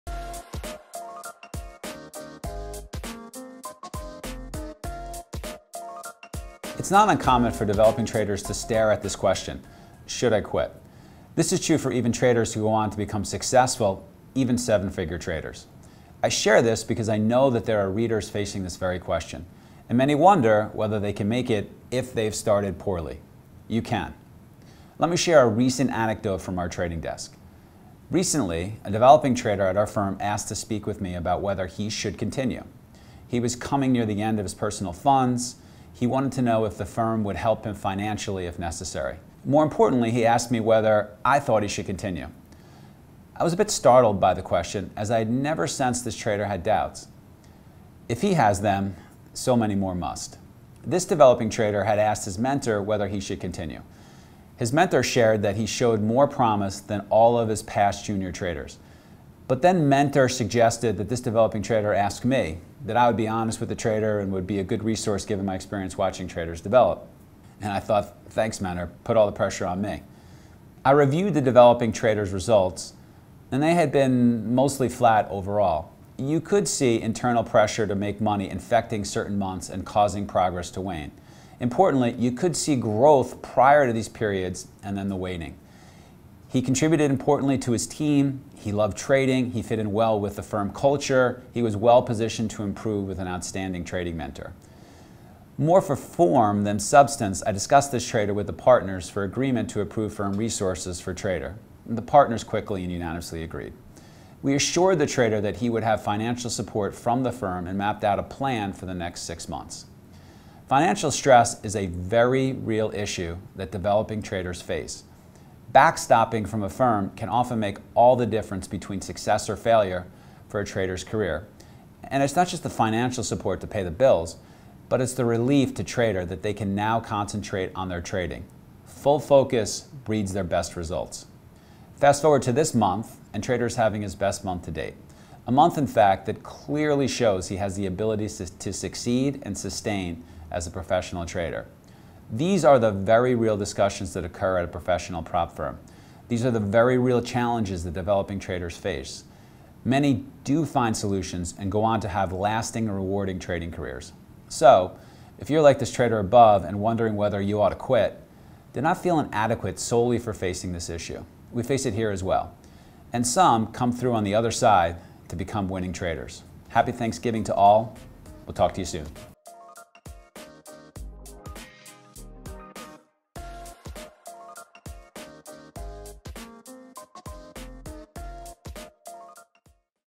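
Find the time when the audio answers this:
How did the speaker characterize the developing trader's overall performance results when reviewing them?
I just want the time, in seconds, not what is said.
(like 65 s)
74 s.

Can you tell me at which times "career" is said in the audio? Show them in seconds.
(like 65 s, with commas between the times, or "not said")
121 s, 153 s.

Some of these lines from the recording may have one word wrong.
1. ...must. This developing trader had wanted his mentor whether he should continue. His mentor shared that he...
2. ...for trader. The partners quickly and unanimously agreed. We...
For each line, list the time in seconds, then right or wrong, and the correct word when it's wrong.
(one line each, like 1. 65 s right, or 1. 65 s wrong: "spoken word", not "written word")
1. 49 s wrong: "asked", not "wanted"
2. 100 s right.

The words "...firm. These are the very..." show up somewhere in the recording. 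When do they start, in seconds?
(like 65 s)
145 s.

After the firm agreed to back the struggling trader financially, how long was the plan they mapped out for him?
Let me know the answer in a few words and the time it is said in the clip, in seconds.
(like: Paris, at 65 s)
6 months, at 109 s.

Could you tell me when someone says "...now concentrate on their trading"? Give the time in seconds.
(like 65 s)
126 s.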